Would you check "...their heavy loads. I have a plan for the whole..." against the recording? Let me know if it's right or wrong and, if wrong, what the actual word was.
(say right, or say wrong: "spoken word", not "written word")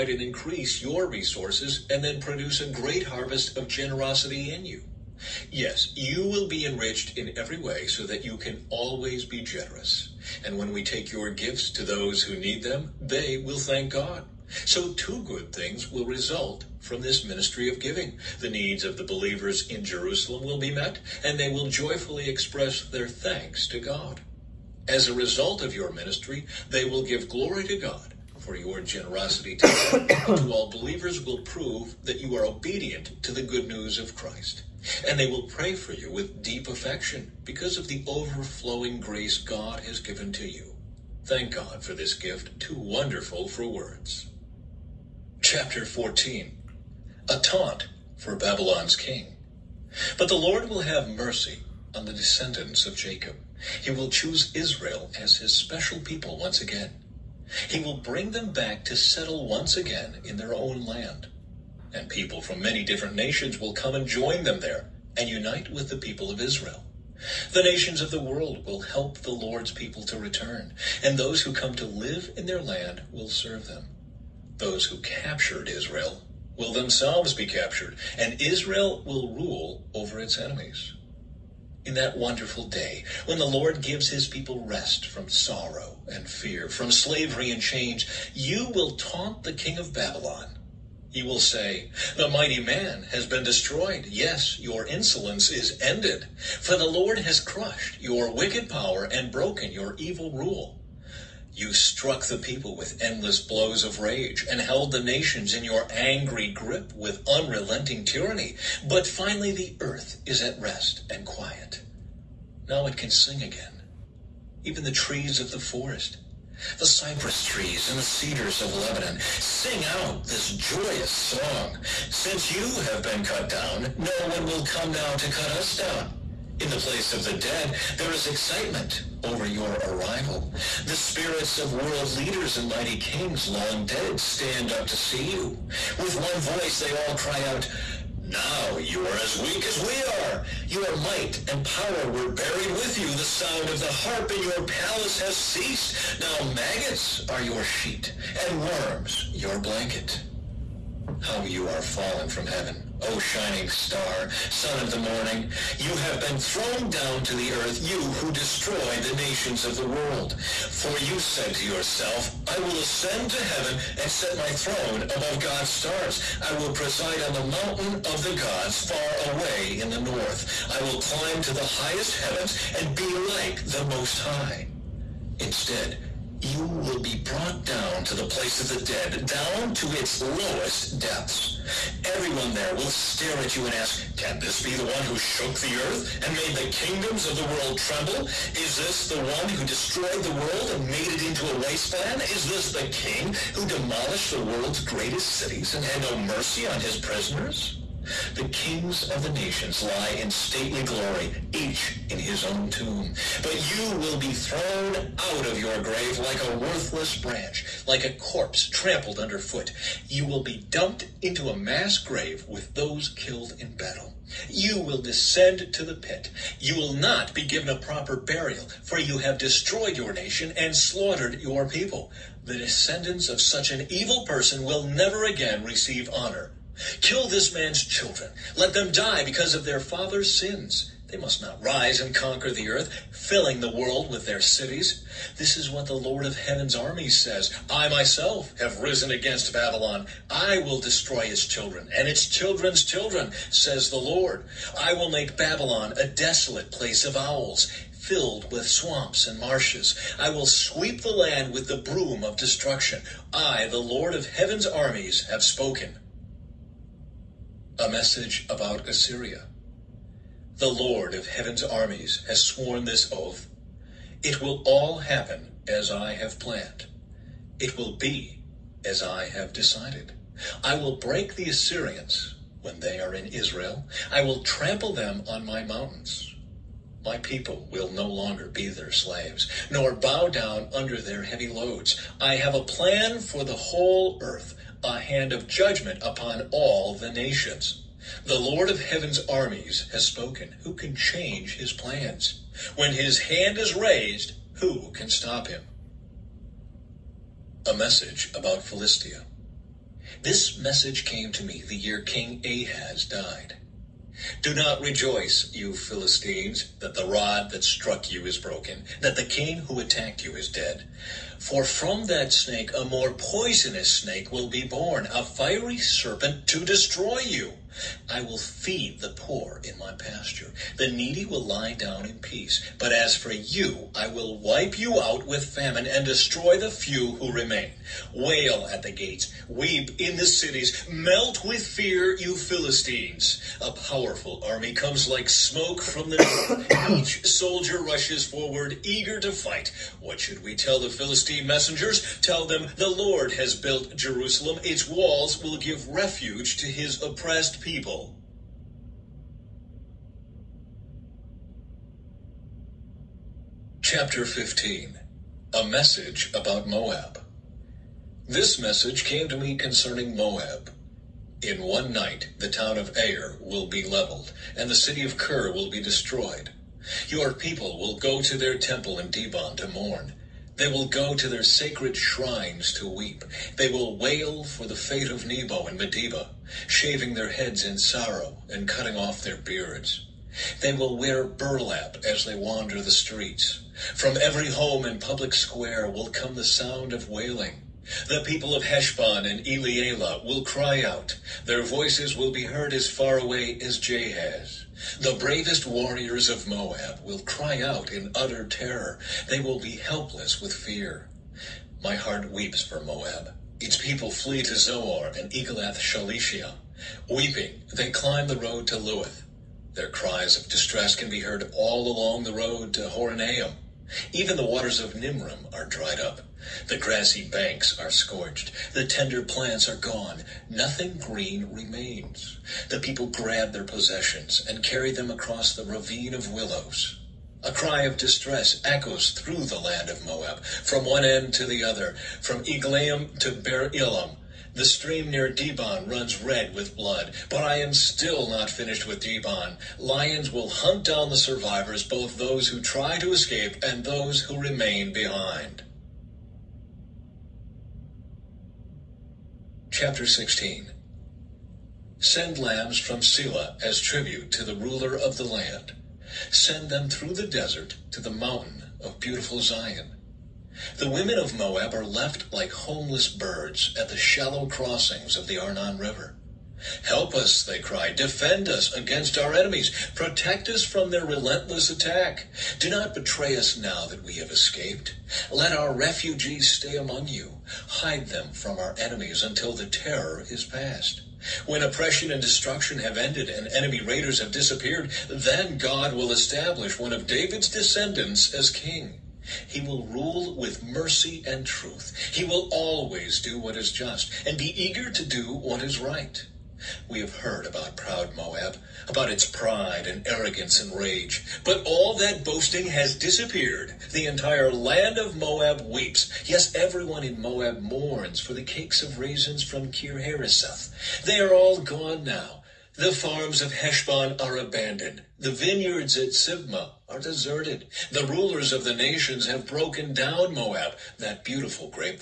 right.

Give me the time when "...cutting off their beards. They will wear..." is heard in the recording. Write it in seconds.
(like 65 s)
378 s.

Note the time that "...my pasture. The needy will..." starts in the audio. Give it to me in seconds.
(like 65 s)
319 s.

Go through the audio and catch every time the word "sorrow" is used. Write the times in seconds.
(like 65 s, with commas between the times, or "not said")
85 s, 377 s.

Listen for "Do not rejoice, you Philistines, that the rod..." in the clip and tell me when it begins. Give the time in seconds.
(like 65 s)
304 s.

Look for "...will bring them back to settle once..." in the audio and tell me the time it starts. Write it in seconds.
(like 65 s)
57 s.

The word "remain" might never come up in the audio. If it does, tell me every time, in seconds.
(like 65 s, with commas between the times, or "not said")
327 s, 421 s, 444 s.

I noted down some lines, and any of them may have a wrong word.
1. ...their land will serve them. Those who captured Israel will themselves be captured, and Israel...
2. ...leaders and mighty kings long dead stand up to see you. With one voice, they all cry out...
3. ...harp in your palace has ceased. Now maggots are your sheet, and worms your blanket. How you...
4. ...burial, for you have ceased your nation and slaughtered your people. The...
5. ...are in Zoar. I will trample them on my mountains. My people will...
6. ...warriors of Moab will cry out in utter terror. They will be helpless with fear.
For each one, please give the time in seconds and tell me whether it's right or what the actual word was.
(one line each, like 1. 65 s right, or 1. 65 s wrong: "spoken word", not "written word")
1. 72 s right
2. 132 s right
3. 143 s right
4. 218 s wrong: "destroyed", not "ceased"
5. 272 s wrong: "Israel", not "Zoar"
6. 395 s right.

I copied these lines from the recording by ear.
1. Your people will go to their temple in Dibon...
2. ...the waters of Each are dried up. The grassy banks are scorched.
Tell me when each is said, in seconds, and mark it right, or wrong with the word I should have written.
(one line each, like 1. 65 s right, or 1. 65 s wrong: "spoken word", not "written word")
1. 367 s right
2. 414 s wrong: "Nimrim", not "Each".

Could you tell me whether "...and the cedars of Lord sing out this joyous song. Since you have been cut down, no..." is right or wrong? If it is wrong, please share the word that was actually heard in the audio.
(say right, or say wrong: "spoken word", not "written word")
wrong: "Lebanon", not "Lord".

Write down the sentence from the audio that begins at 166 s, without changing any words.
I will preside on the mountain of the gods far away in the north.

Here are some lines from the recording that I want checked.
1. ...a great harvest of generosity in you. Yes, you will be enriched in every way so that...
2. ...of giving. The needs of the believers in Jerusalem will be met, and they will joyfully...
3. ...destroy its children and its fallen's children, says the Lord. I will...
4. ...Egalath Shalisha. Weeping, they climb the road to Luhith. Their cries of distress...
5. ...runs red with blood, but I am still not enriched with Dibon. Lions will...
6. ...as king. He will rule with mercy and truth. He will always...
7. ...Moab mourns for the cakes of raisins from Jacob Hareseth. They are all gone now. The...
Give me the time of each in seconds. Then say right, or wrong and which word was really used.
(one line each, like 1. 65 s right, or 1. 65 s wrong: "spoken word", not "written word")
1. 2 s right
2. 17 s right
3. 240 s wrong: "children", not "fallen"
4. 405 s right
5. 435 s wrong: "finished", not "enriched"
6. 488 s right
7. 507 s wrong: "Kir", not "Jacob".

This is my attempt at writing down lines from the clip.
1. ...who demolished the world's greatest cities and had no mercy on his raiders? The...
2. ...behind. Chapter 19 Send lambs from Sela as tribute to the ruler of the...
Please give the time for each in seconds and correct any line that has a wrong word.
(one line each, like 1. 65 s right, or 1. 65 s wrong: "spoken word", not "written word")
1. 193 s wrong: "prisoners", not "raiders"
2. 444 s wrong: "16", not "19".